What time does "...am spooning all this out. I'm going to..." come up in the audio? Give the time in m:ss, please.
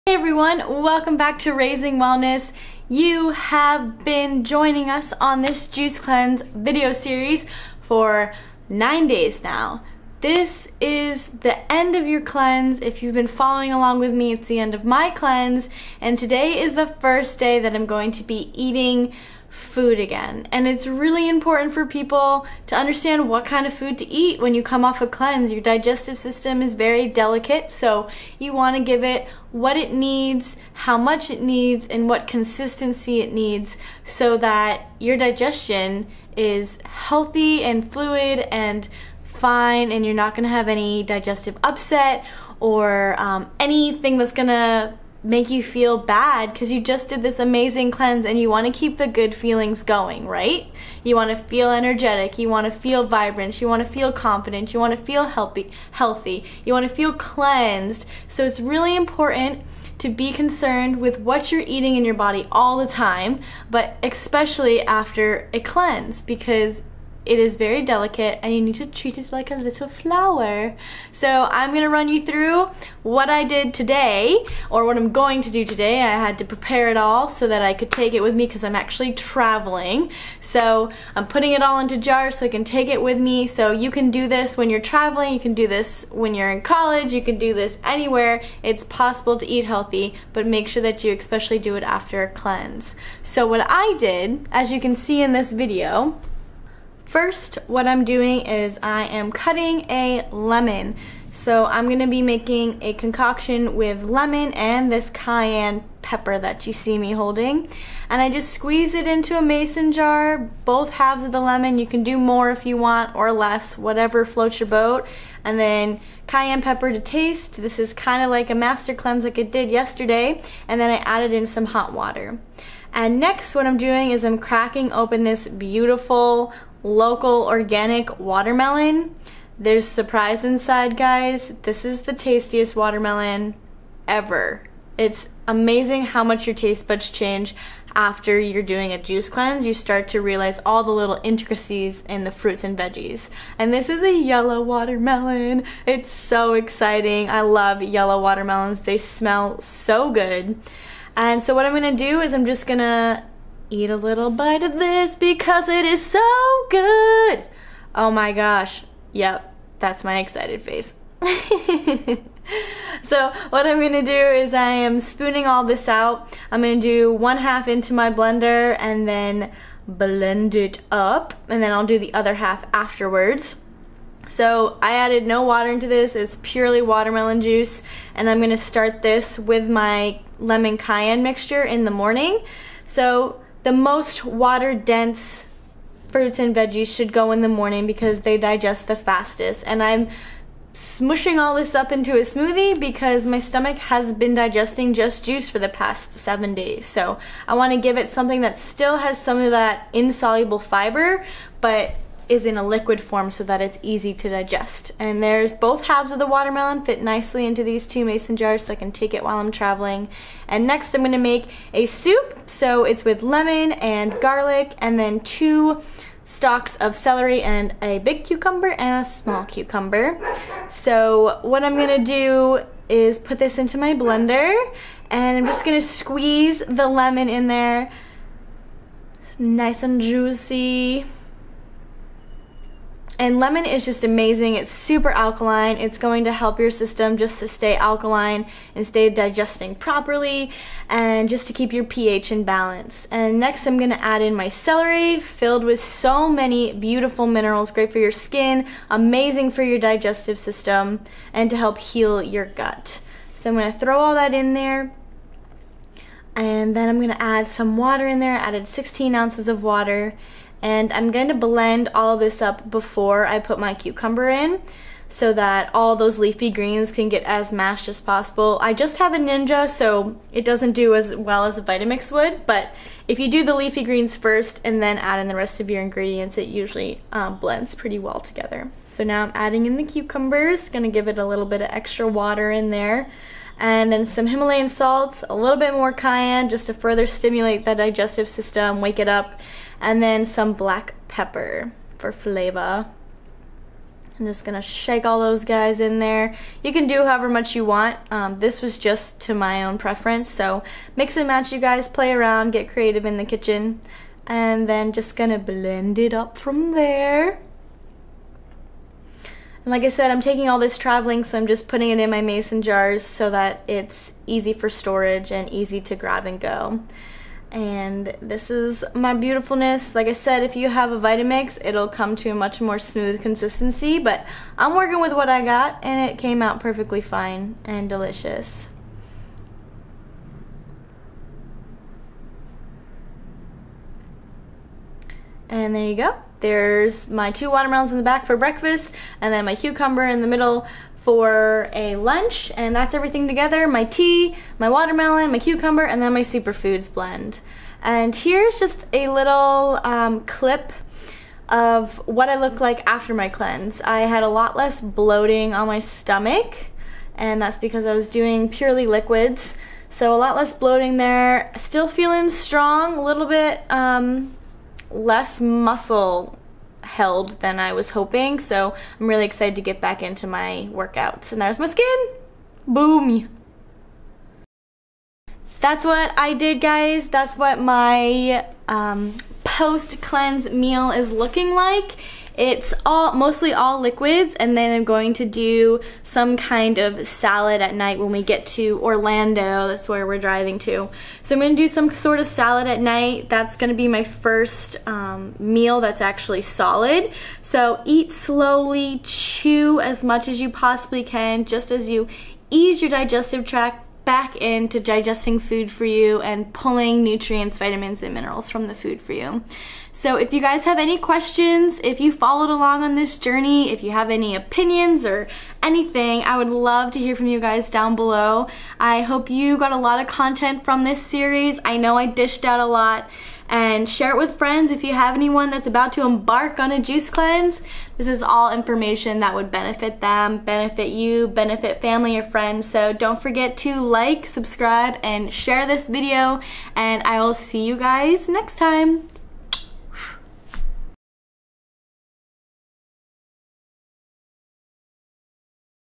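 2:44.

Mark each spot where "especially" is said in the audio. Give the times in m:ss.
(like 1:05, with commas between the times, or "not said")
1:04, 1:31.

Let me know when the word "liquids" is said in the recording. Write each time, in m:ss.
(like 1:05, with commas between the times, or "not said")
3:22, 5:58, 6:23.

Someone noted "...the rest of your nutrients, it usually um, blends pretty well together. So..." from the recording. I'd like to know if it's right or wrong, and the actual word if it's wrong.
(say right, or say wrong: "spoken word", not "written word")
wrong: "ingredients", not "nutrients".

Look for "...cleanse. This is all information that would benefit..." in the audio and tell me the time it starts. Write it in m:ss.
7:07.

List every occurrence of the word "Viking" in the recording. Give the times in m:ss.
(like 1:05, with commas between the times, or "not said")
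not said.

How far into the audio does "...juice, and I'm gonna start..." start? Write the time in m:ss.
2:57.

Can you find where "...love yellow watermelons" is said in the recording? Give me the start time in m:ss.
2:27.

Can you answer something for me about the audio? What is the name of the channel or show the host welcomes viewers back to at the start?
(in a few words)
Raising Wellness.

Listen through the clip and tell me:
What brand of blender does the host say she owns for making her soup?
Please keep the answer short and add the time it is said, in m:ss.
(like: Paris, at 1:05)
Ninja, at 4:29.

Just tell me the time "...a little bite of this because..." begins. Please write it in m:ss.
2:33.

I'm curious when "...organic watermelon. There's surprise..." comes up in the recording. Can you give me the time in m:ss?
2:07.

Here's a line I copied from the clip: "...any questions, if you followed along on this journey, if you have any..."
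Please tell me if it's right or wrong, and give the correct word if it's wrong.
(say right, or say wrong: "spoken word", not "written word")
right.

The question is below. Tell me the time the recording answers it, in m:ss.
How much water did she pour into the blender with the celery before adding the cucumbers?
4:18.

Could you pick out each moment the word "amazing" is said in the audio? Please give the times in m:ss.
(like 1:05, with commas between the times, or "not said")
0:47, 2:15, 3:54, 4:08.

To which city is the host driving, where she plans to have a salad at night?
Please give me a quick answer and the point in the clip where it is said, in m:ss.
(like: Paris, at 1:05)
Orlando, at 6:28.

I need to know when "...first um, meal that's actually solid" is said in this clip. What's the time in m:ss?
6:34.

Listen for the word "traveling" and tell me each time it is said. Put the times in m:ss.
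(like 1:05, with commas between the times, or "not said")
1:19, 1:24, 3:29, 5:10.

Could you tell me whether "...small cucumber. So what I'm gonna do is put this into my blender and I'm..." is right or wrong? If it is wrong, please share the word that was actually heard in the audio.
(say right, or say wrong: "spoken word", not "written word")
right.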